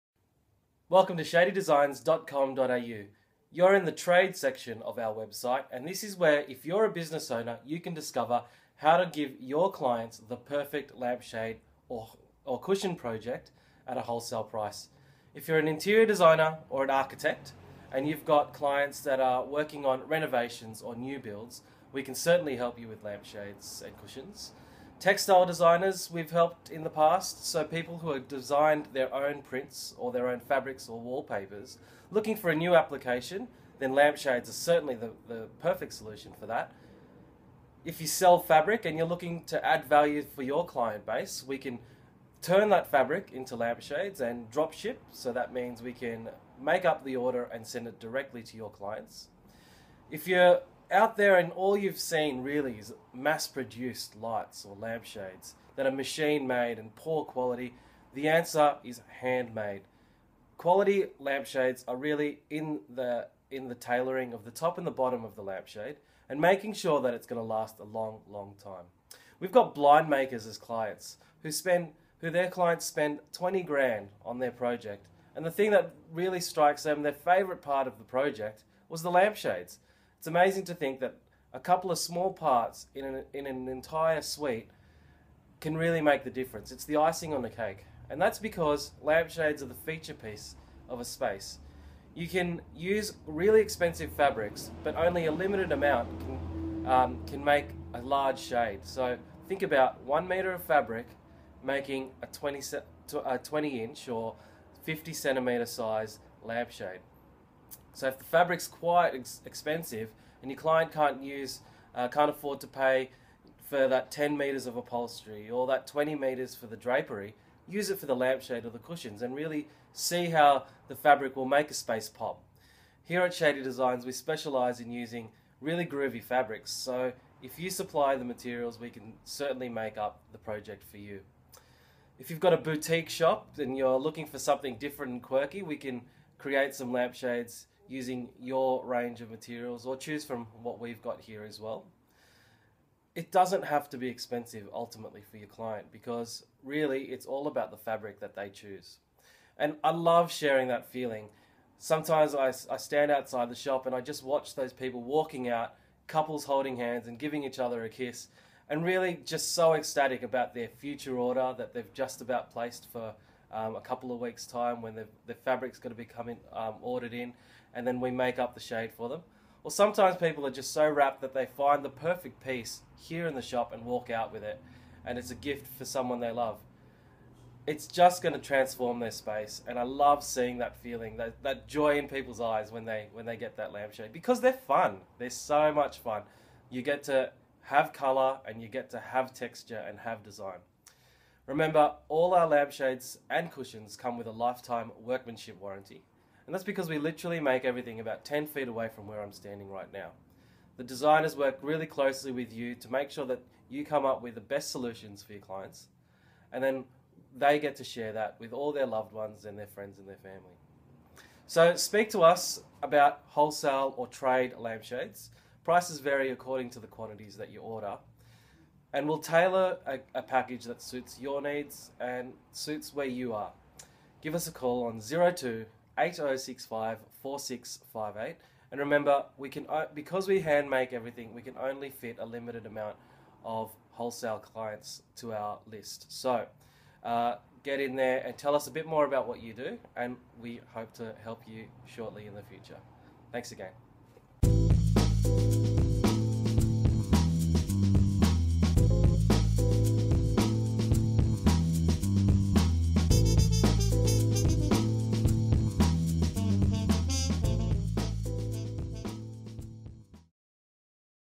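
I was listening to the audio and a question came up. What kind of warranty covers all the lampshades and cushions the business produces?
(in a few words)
Lifetime workmanship warranty.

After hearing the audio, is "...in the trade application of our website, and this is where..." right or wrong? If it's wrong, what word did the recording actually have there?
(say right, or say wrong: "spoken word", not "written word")
wrong: "section", not "application".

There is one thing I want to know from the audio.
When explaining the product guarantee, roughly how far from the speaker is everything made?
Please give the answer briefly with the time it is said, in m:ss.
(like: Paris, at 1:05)
About 10 feet, at 3:17.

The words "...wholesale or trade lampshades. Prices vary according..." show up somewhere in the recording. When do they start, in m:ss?
3:33.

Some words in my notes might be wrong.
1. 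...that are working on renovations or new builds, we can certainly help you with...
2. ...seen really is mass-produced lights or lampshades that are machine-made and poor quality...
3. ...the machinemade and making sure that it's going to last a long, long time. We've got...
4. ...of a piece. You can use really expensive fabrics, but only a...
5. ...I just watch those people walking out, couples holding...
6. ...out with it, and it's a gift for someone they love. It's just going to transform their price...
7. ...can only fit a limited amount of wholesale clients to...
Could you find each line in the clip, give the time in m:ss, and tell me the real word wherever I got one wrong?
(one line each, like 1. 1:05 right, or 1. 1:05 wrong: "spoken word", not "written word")
1. 0:18 right
2. 0:51 right
3. 1:05 wrong: "lampshade", not "machinemade"
4. 1:30 wrong: "space", not "piece"
5. 2:33 right
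6. 2:54 wrong: "space", not "price"
7. 3:51 right.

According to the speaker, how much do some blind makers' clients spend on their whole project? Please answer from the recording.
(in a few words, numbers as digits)
20 grand.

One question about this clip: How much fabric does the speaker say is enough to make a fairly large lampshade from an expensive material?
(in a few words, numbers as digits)
1 meter.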